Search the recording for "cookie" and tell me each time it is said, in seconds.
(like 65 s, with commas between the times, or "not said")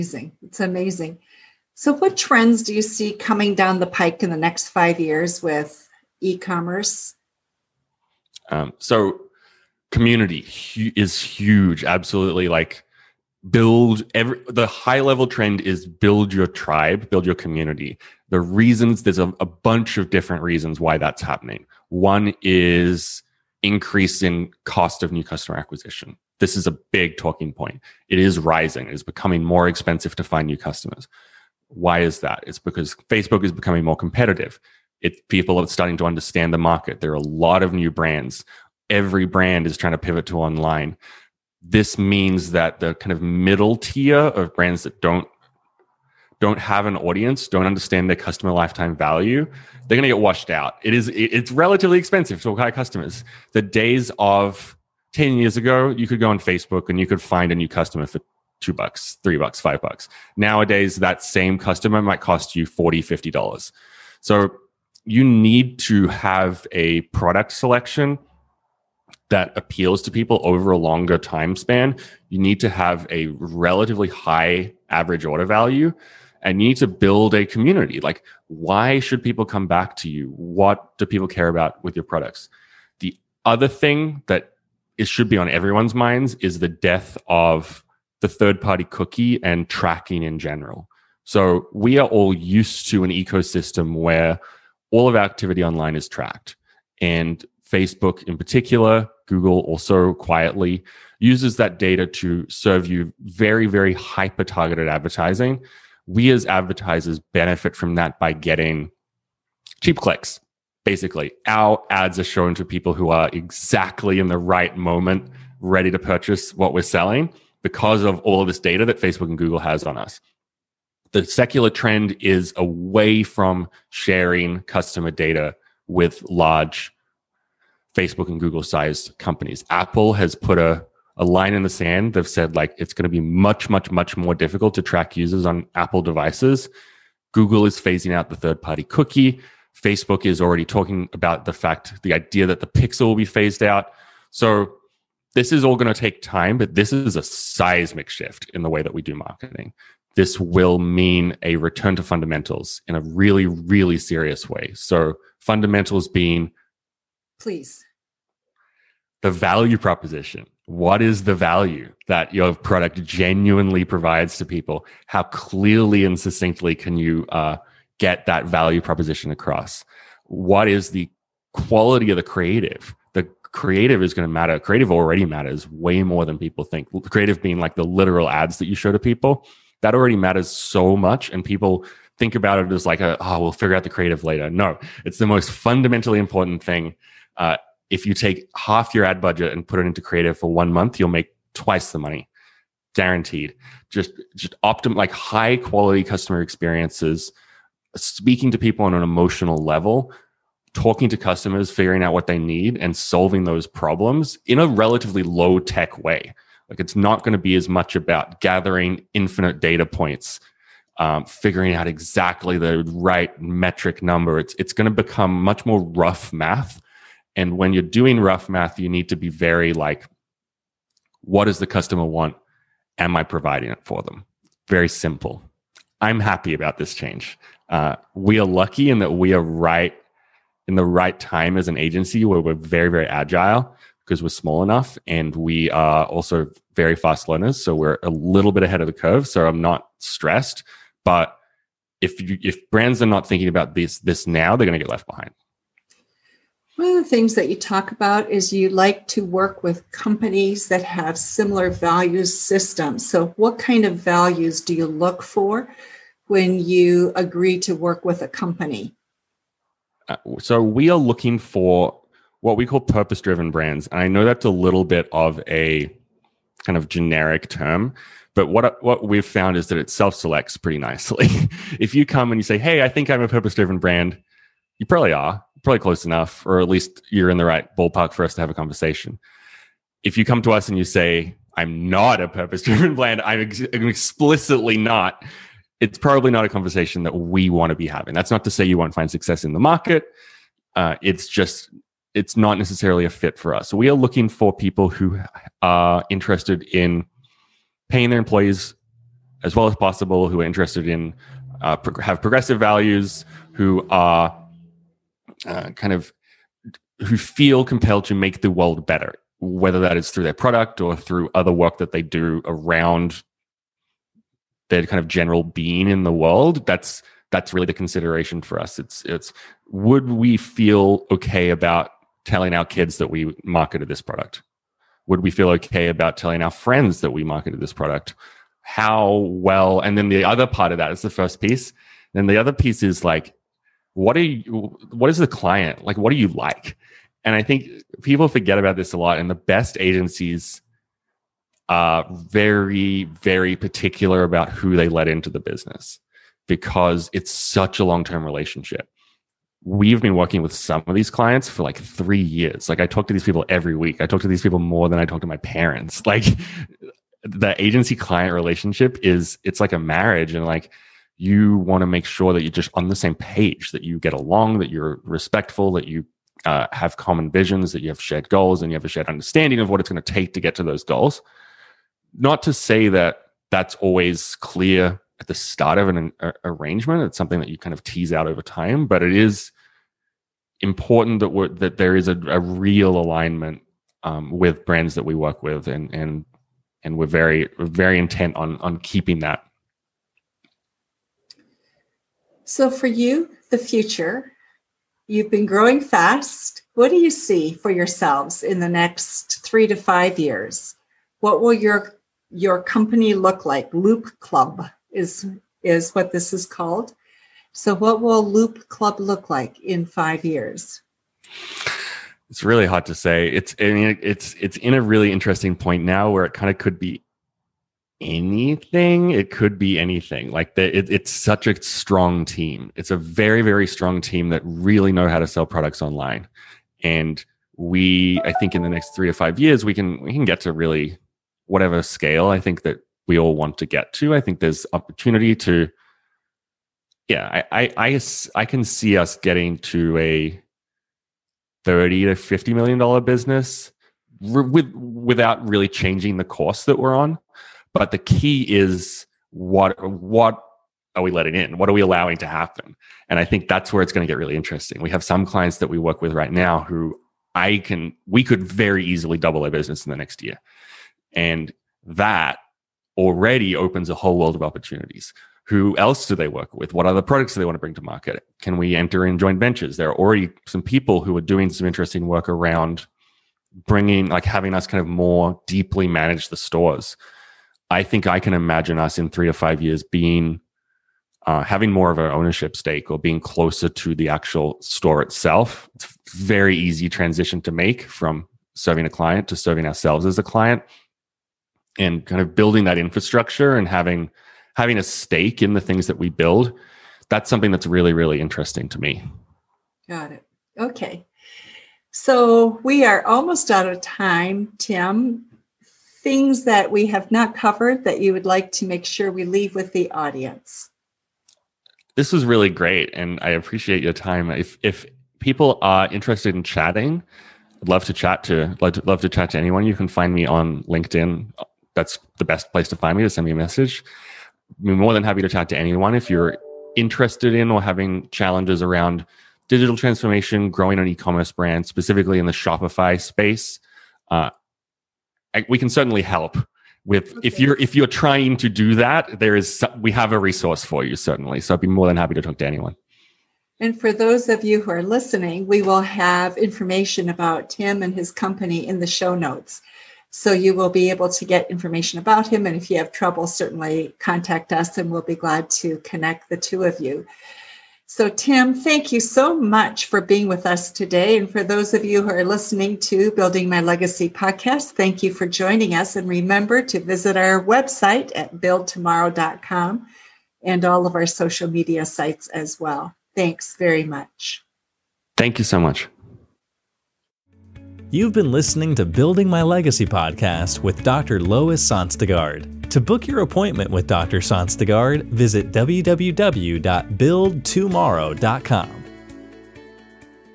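88 s, 138 s.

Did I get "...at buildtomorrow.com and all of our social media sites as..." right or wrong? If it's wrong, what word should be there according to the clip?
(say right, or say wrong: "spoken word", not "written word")
right.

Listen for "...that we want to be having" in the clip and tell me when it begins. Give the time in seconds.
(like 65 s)
287 s.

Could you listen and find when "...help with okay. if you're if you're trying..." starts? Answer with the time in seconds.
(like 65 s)
536 s.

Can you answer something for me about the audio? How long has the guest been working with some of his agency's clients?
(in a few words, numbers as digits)
3 years.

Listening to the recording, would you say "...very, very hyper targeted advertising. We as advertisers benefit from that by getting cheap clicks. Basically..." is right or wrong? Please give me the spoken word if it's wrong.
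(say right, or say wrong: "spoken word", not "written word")
right.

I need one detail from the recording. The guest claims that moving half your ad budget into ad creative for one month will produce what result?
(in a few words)
twice the money.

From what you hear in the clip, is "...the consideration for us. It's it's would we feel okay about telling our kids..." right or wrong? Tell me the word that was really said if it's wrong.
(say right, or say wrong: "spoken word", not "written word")
right.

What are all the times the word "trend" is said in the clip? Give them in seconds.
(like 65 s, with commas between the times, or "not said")
2 s, 15 s, 121 s.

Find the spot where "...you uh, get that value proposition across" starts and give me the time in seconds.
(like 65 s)
166 s.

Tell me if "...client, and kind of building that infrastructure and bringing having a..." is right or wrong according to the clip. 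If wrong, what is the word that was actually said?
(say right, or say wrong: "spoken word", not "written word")
wrong: "having", not "bringing".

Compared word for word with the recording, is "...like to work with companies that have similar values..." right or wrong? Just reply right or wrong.
right.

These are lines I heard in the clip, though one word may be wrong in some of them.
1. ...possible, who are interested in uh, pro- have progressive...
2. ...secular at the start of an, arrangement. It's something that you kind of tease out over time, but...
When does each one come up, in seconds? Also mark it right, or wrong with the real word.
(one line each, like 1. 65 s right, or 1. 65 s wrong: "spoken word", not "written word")
1. 299 s right
2. 374 s wrong: "clear", not "secular".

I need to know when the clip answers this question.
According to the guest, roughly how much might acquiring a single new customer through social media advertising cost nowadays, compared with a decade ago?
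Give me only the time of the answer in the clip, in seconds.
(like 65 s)
62 s.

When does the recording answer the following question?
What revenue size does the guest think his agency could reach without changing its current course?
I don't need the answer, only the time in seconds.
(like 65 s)
441 s.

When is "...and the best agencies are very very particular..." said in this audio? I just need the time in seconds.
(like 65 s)
339 s.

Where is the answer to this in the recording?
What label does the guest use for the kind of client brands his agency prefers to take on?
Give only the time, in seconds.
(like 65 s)
262 s.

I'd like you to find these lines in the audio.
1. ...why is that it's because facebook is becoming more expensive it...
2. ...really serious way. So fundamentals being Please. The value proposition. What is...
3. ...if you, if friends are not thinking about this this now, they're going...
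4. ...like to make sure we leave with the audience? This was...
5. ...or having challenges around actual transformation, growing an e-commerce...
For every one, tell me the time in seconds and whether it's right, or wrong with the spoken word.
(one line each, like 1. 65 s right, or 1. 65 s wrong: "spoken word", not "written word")
1. 31 s wrong: "competitive", not "expensive"
2. 153 s right
3. 241 s wrong: "brands", not "friends"
4. 508 s right
5. 527 s wrong: "digital", not "actual".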